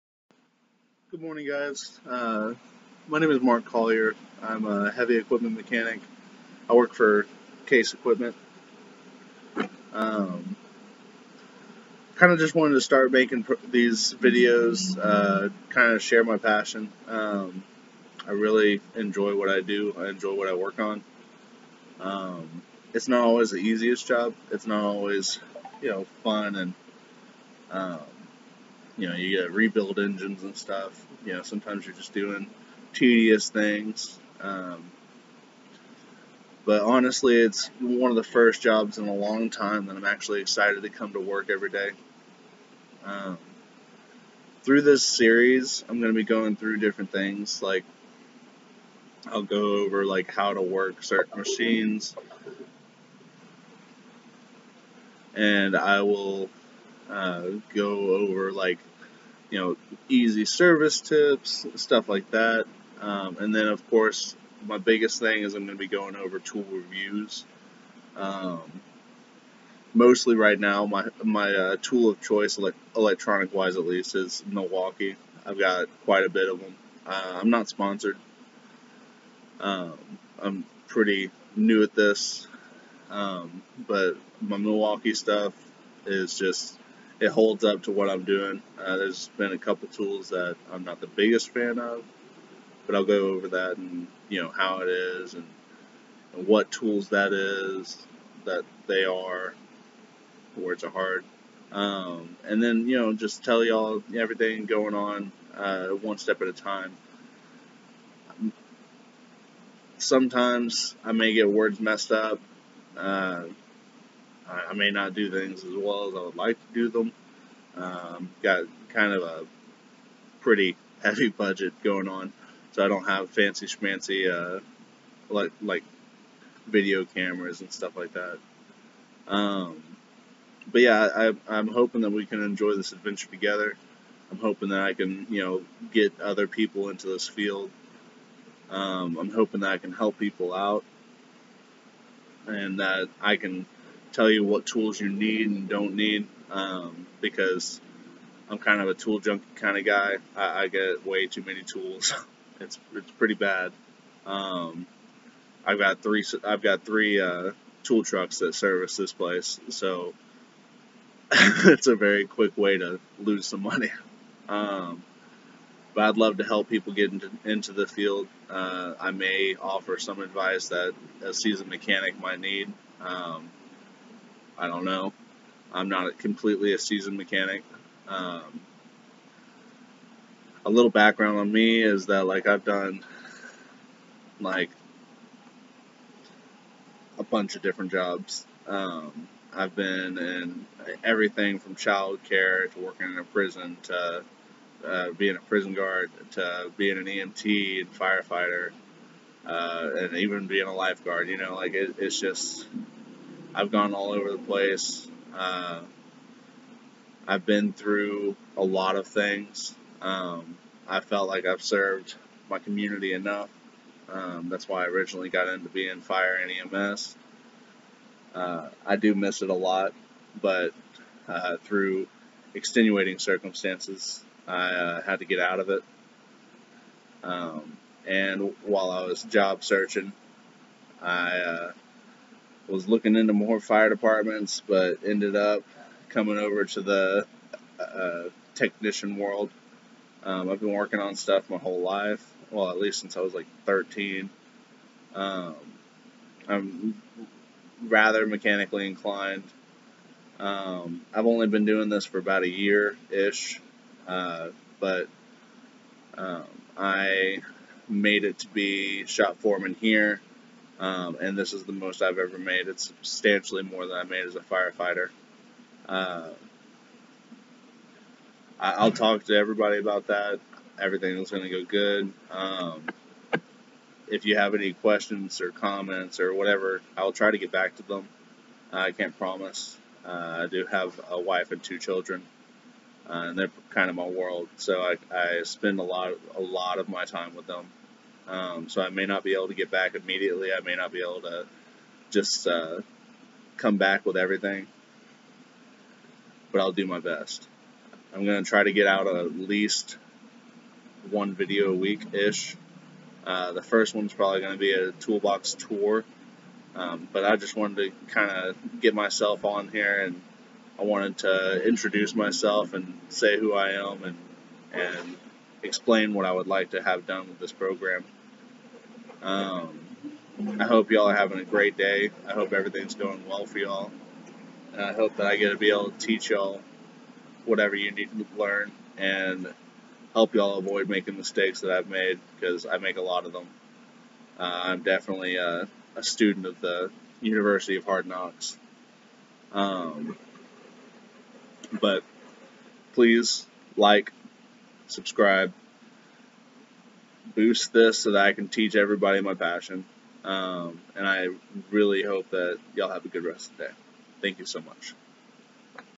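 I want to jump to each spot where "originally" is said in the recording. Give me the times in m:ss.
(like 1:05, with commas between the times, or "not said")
3:34.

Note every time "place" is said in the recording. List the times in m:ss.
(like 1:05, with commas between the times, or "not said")
2:39, 3:24.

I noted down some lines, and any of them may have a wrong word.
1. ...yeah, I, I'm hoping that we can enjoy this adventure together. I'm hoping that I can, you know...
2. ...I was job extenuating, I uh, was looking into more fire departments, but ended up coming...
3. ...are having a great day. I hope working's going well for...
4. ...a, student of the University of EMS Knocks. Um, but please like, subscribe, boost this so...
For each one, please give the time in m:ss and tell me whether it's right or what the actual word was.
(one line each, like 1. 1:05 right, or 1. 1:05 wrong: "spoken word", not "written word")
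1. 2:10 right
2. 3:48 wrong: "searching", not "extenuating"
3. 5:21 wrong: "everything", not "working"
4. 5:35 wrong: "Hard", not "EMS".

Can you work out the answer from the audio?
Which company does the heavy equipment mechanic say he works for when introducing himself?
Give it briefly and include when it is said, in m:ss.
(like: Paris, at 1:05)
Case Equipment, at 0:07.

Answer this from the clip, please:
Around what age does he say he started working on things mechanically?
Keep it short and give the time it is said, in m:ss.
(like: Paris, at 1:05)
13, at 4:03.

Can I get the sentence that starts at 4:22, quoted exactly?
It's substantially more than I made as a firefighter.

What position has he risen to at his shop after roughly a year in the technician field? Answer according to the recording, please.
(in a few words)
shop foreman.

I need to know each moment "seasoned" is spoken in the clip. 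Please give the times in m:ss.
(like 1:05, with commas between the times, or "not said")
2:51, 2:56.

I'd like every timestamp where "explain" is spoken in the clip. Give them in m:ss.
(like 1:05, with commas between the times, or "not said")
5:15.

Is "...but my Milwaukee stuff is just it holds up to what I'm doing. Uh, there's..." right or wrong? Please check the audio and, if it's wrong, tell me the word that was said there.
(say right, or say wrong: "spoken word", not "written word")
right.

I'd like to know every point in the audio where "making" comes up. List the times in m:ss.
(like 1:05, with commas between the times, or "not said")
0:13, 5:30.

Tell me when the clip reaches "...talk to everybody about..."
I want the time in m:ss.
4:28.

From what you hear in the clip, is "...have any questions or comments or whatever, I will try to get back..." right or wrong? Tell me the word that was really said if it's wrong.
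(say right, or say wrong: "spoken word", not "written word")
right.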